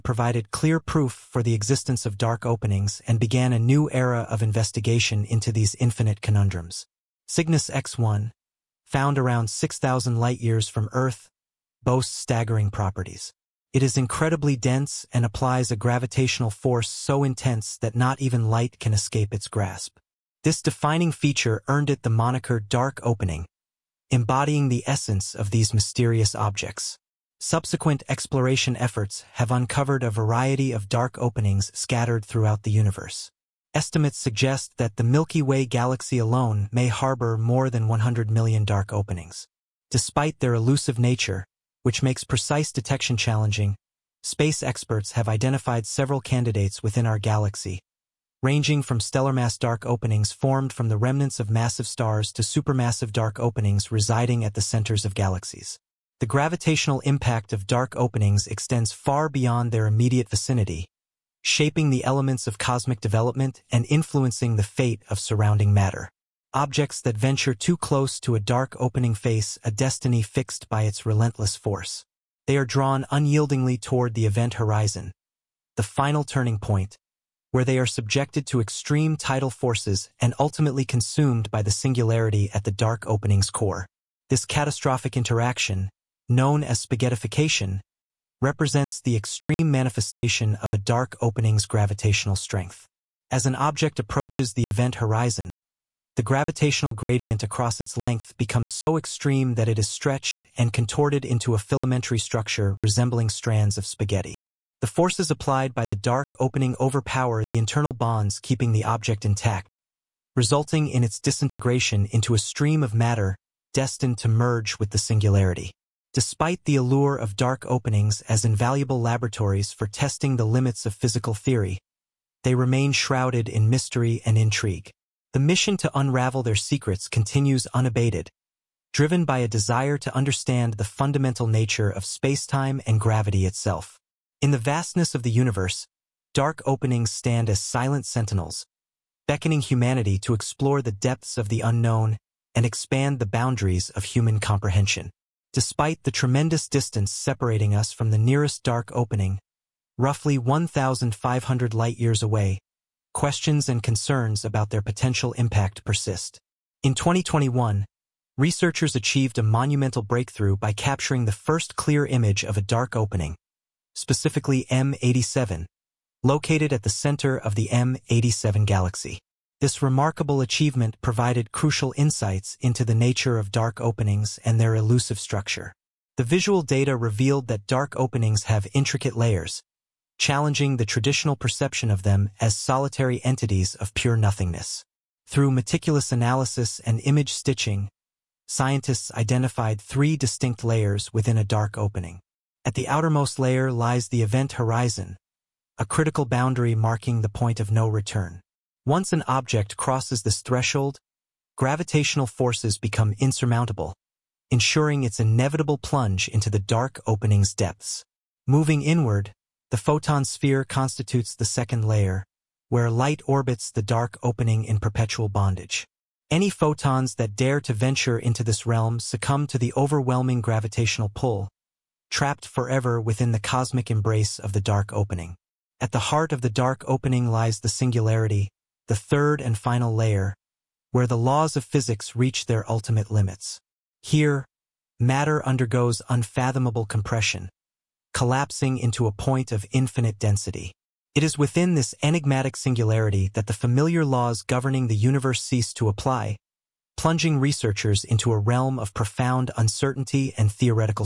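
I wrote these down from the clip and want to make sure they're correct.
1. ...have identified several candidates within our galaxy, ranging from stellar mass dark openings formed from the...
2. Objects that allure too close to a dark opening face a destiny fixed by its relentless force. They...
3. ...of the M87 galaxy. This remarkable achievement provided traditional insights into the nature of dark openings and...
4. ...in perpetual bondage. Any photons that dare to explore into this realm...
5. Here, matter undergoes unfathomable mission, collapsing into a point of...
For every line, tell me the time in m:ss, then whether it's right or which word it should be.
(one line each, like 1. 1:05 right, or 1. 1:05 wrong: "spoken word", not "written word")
1. 0:45 right
2. 1:06 wrong: "venture", not "allure"
3. 2:47 wrong: "crucial", not "traditional"
4. 3:34 wrong: "venture", not "explore"
5. 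3:54 wrong: "compression", not "mission".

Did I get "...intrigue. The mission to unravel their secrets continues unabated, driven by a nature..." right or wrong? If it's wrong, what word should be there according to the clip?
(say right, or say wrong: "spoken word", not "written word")
wrong: "desire", not "nature".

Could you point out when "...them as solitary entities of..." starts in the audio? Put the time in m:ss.
3:02.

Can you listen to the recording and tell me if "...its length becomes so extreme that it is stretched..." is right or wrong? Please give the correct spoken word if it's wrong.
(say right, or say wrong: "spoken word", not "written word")
right.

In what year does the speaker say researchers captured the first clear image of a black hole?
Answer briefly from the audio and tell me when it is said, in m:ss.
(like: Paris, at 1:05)
2021, at 2:36.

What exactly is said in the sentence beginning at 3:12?
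At the outermost layer lies the event horizon, a critical boundary marking the point of no return.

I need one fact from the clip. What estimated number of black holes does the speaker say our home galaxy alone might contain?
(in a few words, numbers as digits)
more than 100 million.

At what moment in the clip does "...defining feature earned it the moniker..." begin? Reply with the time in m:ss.
0:20.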